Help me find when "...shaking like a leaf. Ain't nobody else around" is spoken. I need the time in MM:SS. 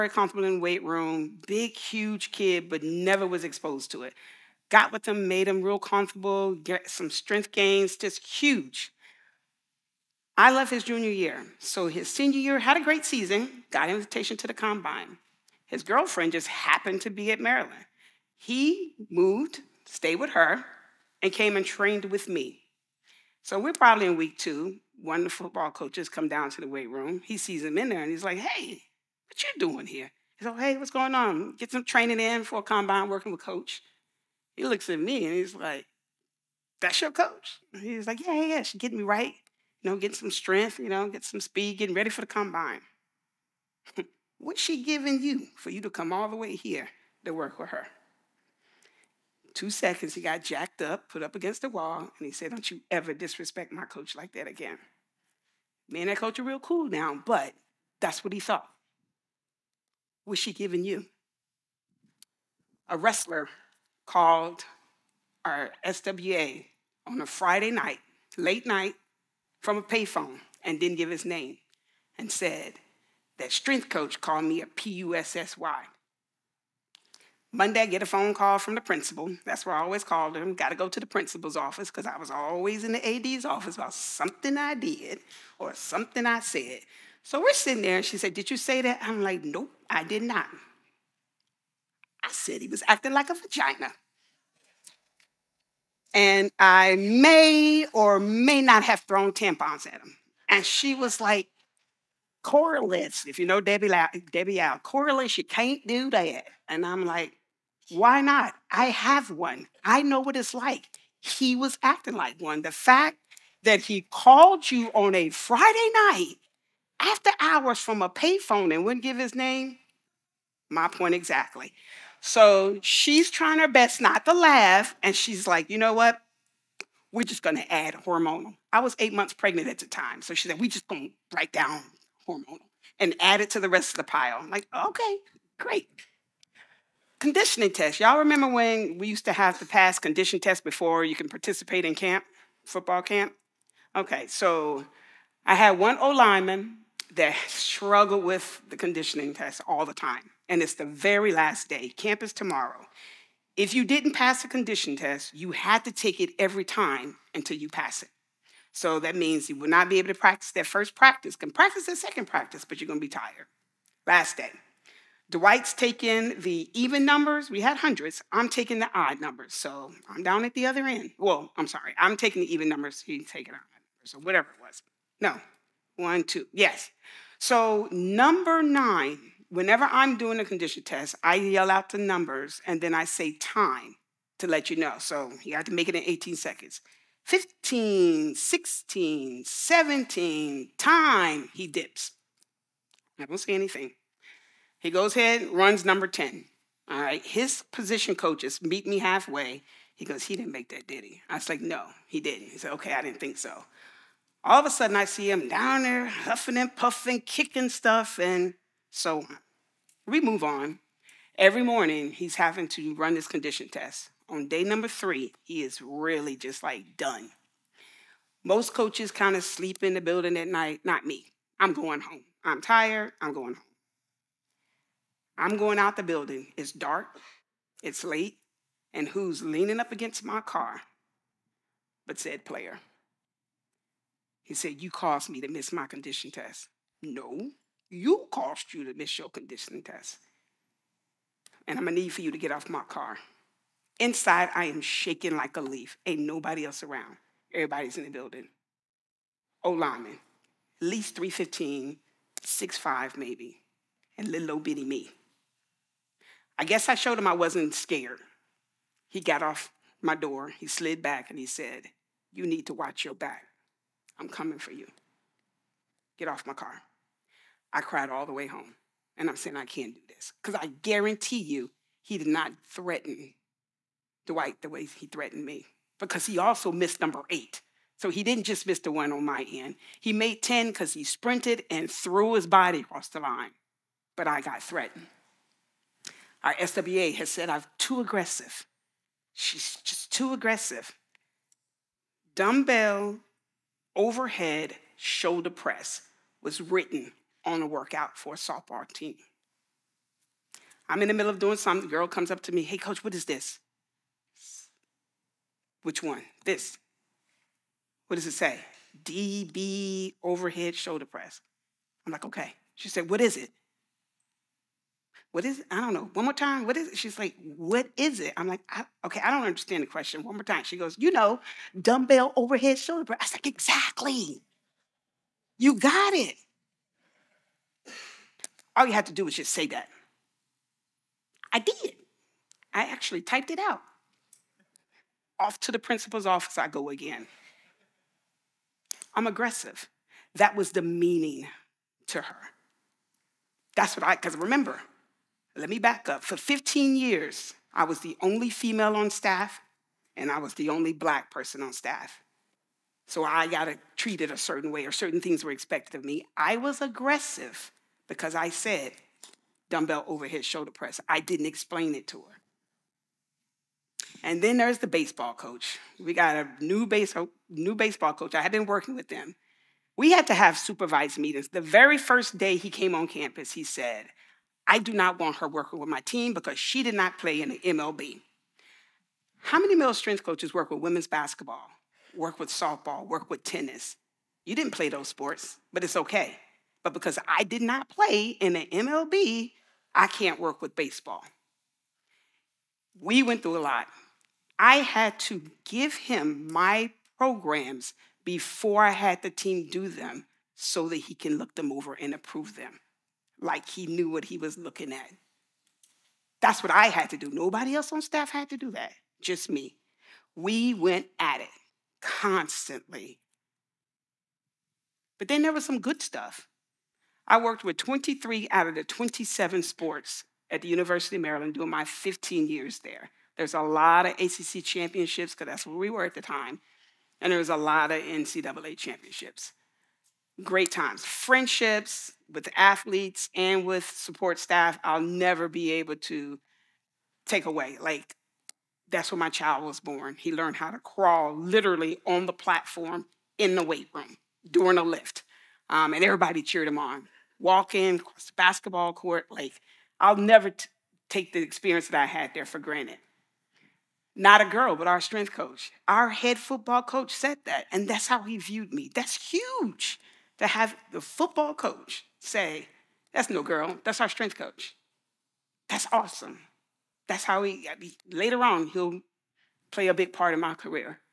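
04:04.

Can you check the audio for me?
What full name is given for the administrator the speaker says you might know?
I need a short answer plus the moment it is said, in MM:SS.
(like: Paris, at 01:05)
Debbie Yow, at 01:44.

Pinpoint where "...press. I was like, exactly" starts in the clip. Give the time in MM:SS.
05:23.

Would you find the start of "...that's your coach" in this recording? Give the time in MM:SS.
00:36.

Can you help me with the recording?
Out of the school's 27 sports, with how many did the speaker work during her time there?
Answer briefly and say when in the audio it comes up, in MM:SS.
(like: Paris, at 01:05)
23, at 06:57.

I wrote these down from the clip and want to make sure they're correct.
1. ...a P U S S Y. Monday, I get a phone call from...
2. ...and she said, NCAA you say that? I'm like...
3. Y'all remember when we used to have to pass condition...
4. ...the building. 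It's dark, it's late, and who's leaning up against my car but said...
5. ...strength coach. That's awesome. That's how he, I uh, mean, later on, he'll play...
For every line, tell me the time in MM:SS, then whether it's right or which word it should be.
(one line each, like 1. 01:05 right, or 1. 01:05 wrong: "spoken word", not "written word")
1. 01:14 right
2. 01:27 wrong: "Did", not "NCAA"
3. 02:18 right
4. 03:45 right
5. 07:44 right.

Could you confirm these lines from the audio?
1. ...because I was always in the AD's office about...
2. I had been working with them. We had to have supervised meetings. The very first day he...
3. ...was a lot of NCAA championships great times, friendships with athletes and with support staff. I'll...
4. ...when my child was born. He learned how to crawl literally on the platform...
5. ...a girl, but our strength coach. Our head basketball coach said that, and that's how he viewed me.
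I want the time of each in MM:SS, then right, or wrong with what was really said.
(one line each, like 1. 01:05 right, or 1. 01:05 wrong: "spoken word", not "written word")
1. 01:21 right
2. 06:08 right
3. 07:07 right
4. 07:19 right
5. 07:34 wrong: "football", not "basketball".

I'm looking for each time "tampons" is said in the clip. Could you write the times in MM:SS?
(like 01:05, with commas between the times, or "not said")
01:39.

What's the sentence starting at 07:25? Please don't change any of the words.
Um, and everybody cheered him on.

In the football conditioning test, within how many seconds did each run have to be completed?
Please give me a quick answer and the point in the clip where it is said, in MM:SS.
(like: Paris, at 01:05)
18 seconds, at 03:06.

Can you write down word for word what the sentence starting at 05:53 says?
So I got treated a certain way, or certain things were expected of me.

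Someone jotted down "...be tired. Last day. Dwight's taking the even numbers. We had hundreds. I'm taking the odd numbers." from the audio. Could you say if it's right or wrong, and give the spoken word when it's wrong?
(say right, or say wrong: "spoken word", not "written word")
right.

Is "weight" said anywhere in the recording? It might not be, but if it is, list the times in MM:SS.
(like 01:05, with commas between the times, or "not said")
00:00, 00:26, 07:23.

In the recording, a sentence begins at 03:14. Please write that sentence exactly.
He goes ahead, runs number 10.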